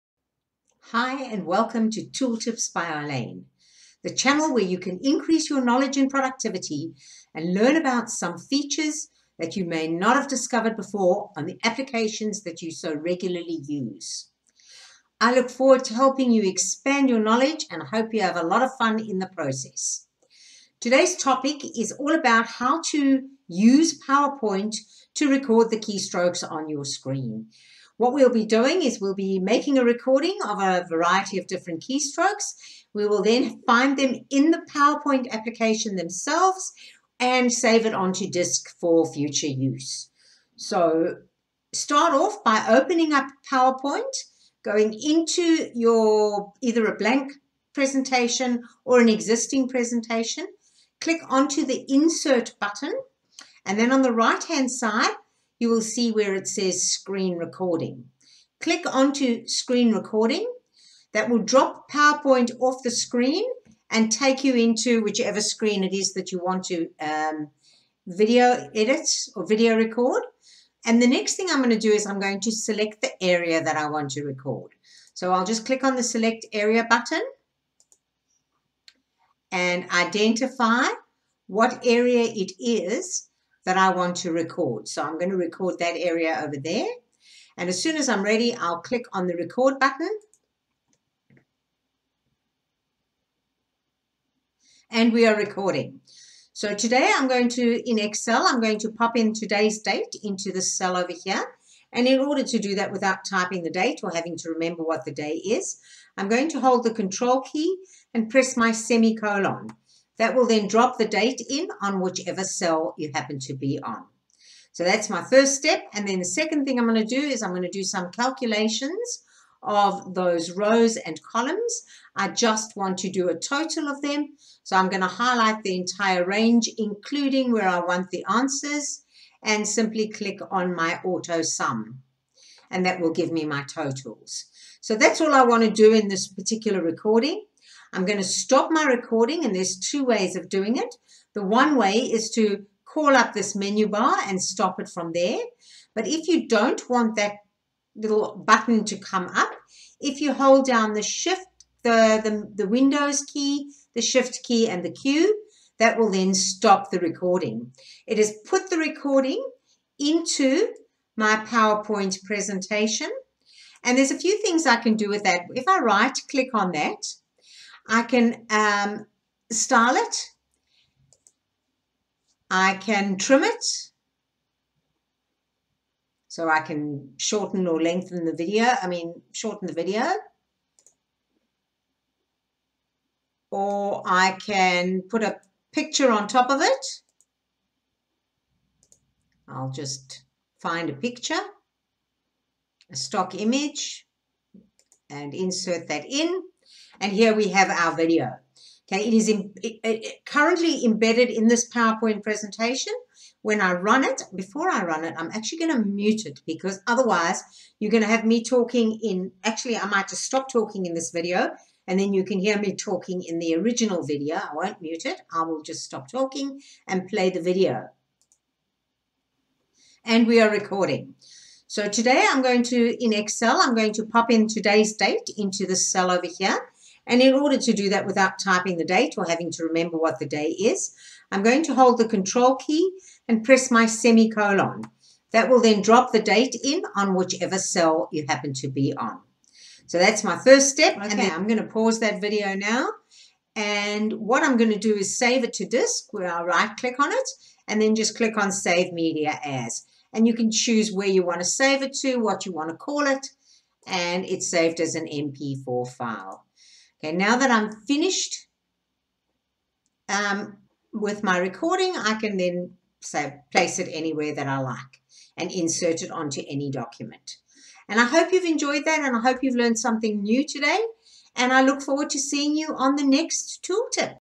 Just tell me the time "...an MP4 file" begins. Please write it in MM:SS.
04:14.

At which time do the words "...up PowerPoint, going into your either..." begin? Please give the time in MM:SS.
00:43.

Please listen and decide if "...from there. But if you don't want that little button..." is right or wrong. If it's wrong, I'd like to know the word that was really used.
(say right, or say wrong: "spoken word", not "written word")
right.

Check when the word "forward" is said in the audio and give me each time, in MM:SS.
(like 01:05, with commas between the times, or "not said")
00:15, 04:31.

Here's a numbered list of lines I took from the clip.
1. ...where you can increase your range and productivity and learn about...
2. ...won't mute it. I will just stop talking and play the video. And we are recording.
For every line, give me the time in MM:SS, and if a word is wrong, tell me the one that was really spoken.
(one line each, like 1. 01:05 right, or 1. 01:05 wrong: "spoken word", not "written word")
1. 00:04 wrong: "knowledge", not "range"
2. 03:34 right.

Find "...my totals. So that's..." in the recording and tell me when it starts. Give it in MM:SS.
02:13.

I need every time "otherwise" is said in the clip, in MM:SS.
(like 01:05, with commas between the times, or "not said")
03:26.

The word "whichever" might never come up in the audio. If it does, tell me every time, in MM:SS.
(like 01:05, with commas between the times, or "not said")
01:05, 01:52, 03:57.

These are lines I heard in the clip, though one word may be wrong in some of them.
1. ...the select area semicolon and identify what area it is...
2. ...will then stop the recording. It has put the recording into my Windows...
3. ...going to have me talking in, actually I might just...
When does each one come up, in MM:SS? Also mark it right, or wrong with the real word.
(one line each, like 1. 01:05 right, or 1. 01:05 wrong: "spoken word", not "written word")
1. 01:15 wrong: "button", not "semicolon"
2. 02:35 wrong: "PowerPoint", not "Windows"
3. 03:27 right.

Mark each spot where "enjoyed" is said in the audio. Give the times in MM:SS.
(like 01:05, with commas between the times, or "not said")
04:28.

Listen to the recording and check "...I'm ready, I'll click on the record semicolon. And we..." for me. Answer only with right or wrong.
wrong.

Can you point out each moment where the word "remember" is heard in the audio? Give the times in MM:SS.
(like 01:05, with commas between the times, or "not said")
01:44, 03:49.